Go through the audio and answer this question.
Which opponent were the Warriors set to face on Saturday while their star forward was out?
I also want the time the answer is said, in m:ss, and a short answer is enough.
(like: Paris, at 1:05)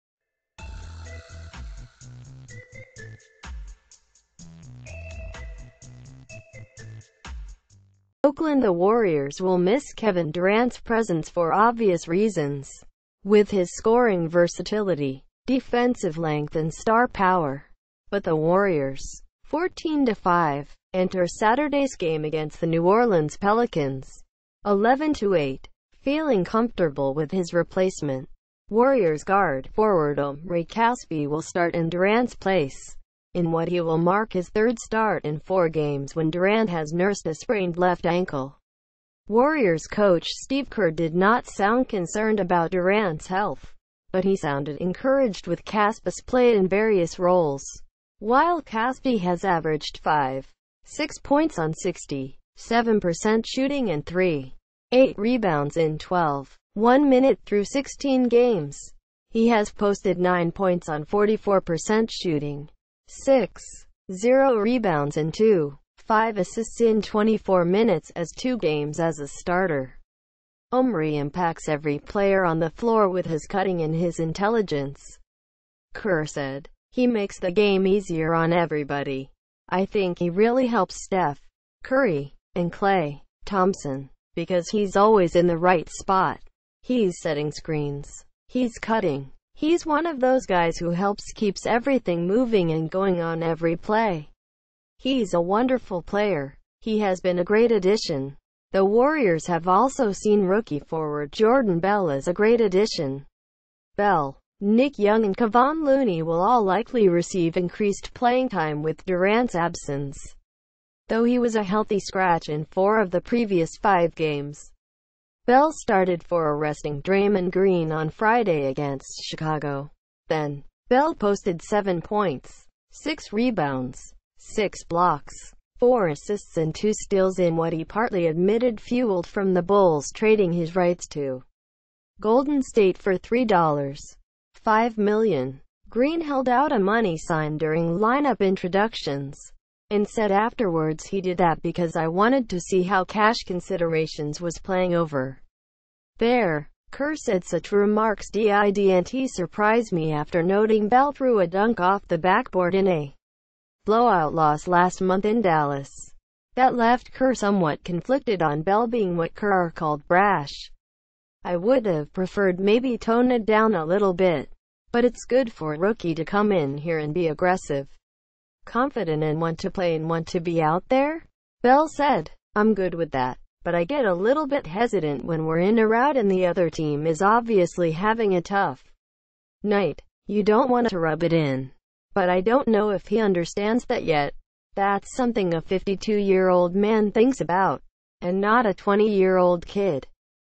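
New Orleans Pelicans, at 0:22.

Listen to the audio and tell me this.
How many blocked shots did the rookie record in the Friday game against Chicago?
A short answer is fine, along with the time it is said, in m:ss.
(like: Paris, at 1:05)
6, at 2:04.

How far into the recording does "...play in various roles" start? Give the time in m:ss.
0:46.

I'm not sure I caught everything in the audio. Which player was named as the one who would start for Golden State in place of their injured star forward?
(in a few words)
Omri Casspi.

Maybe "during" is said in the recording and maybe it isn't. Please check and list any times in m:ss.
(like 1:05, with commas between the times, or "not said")
2:17.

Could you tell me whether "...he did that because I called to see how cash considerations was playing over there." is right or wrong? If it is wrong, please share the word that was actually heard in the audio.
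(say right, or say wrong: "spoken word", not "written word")
wrong: "wanted", not "called".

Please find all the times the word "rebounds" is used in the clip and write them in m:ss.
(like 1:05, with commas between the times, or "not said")
0:55, 1:04, 2:03.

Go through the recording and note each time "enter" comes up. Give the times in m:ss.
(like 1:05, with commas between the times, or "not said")
0:20.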